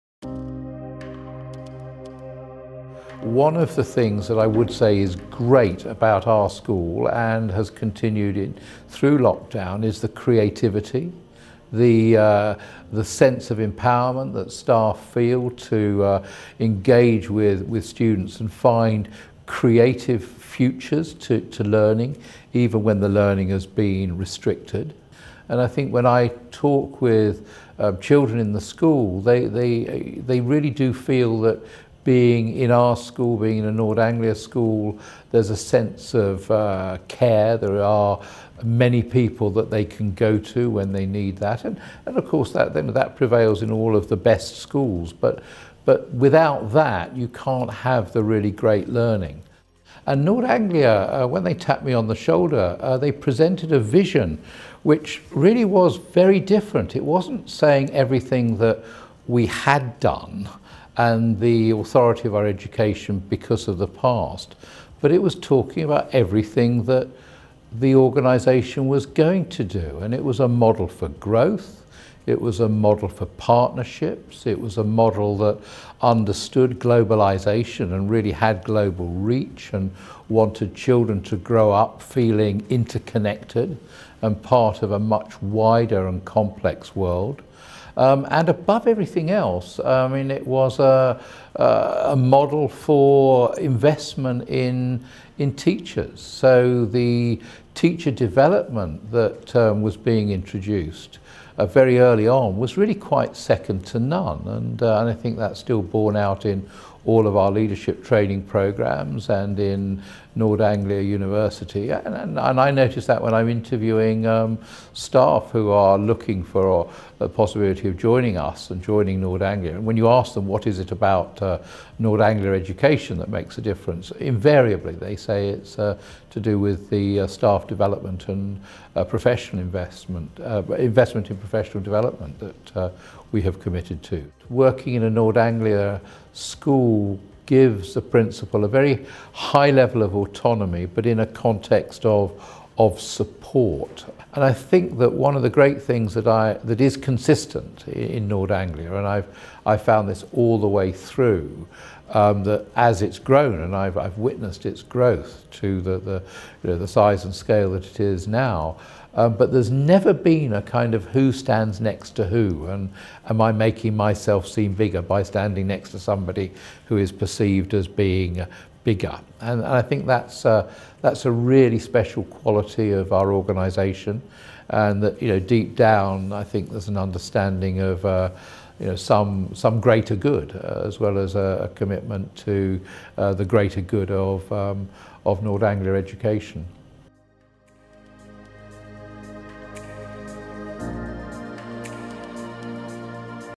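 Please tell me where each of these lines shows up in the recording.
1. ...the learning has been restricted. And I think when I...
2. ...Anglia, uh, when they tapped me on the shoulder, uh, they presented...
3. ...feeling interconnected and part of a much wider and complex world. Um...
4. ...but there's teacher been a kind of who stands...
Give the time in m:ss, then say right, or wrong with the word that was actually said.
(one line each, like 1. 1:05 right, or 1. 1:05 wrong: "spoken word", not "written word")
1. 0:23 right
2. 0:50 right
3. 1:22 right
4. 2:39 wrong: "never", not "teacher".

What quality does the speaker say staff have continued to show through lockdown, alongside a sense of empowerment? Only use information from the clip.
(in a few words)
creativity.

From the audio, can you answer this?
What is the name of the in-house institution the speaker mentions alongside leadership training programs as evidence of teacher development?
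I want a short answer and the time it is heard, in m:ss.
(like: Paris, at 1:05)
Nord Anglia University, at 1:50.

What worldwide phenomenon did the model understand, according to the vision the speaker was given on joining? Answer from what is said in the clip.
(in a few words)
globalization.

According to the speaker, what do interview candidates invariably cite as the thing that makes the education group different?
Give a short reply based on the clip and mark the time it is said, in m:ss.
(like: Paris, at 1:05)
staff development, at 2:07.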